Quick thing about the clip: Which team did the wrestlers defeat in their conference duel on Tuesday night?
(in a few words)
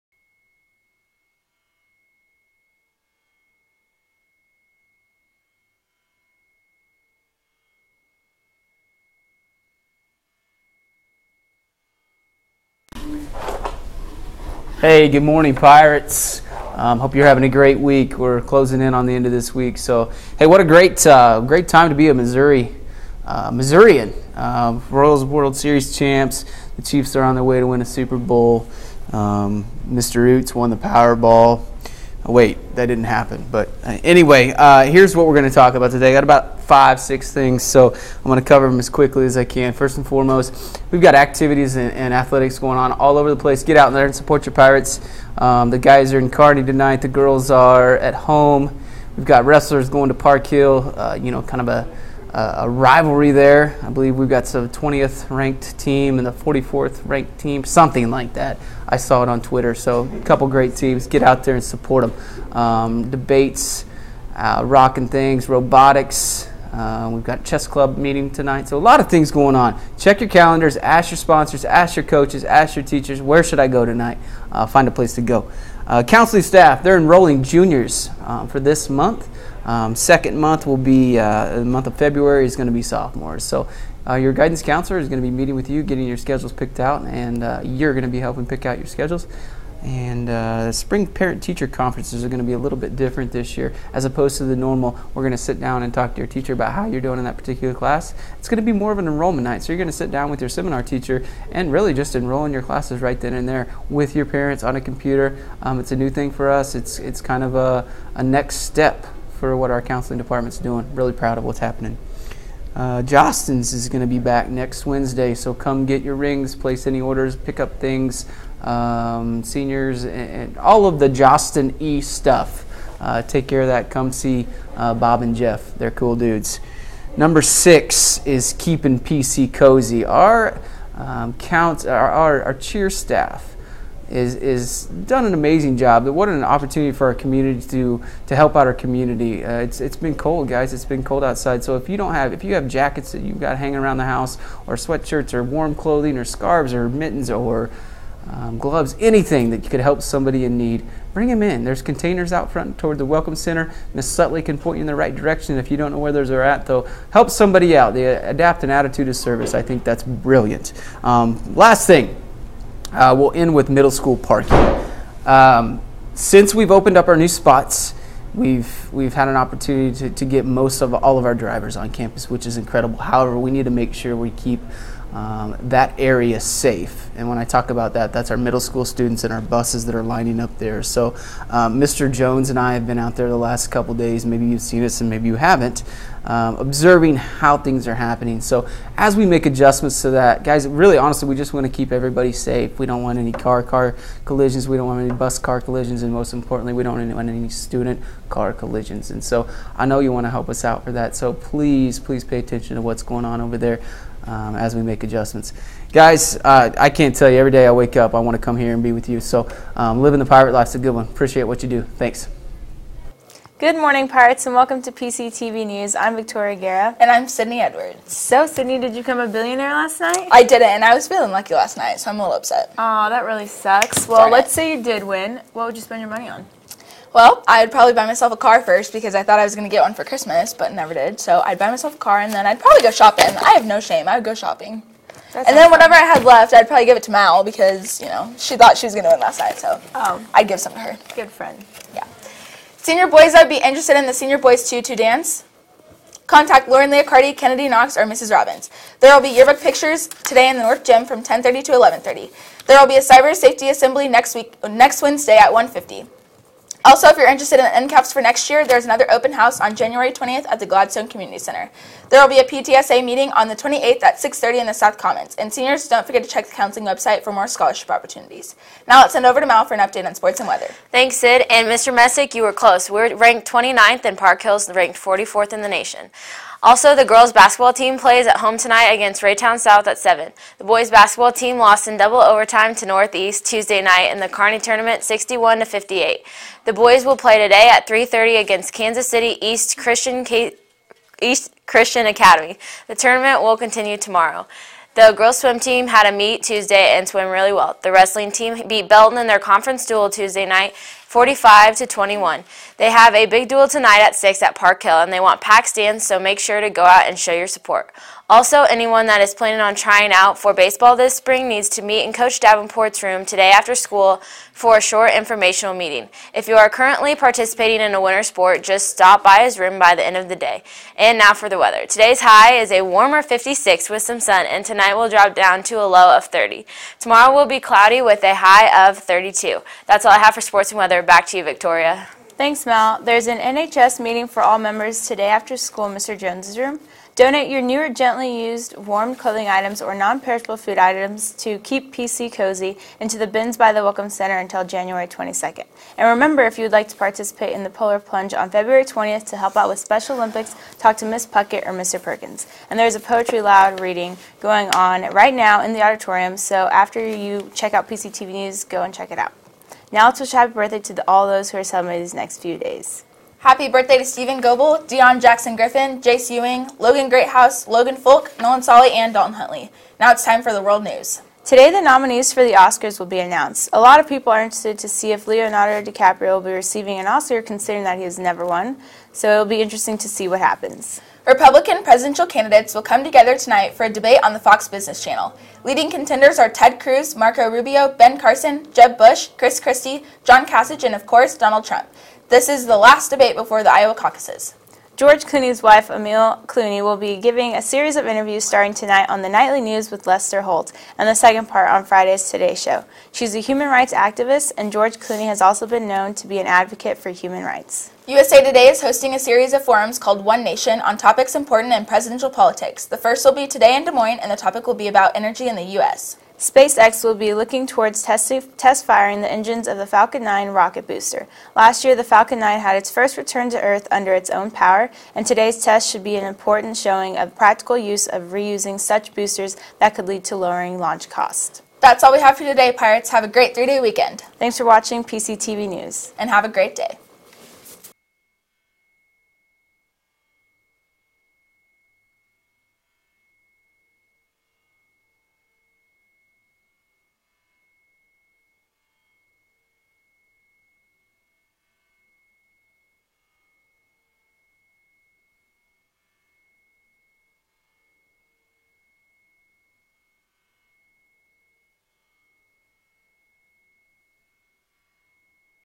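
Belton.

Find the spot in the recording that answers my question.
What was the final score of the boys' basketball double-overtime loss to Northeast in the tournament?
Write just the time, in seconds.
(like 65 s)
285 s.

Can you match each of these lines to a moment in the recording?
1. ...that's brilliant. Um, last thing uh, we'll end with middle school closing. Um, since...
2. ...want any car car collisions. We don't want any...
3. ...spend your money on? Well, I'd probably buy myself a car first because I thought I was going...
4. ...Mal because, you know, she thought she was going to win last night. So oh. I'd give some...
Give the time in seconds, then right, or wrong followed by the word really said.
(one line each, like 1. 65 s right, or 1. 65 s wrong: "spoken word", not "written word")
1. 159 s wrong: "parking", not "closing"
2. 193 s right
3. 225 s right
4. 237 s right.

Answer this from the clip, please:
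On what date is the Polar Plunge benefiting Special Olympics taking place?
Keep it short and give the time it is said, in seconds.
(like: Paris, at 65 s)
February 20th, at 348 s.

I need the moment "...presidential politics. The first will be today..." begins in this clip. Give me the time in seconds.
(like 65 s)
411 s.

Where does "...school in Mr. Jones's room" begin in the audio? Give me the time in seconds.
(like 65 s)
335 s.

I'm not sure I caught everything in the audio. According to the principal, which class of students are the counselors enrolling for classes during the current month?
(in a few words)
Juniors.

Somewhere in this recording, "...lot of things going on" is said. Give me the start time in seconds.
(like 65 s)
68 s.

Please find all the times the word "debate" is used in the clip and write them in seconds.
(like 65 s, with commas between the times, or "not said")
63 s, 383 s, 393 s.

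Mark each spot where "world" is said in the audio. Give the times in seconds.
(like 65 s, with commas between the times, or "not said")
25 s, 370 s.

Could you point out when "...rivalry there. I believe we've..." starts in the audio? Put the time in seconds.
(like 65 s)
52 s.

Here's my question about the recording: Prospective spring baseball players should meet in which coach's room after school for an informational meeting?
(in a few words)
Coach Davenport.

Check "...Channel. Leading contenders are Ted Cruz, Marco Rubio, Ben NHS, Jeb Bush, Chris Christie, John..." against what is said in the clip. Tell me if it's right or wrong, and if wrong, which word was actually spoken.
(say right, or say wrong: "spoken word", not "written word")
wrong: "Carson", not "NHS".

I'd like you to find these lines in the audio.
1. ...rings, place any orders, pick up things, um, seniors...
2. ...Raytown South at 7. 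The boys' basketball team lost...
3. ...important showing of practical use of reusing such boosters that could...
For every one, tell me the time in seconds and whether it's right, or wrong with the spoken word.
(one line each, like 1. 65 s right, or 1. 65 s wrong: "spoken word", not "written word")
1. 116 s right
2. 279 s right
3. 426 s right.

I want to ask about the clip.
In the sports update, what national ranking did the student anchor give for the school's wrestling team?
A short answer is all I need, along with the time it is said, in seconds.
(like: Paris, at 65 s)
29th, at 273 s.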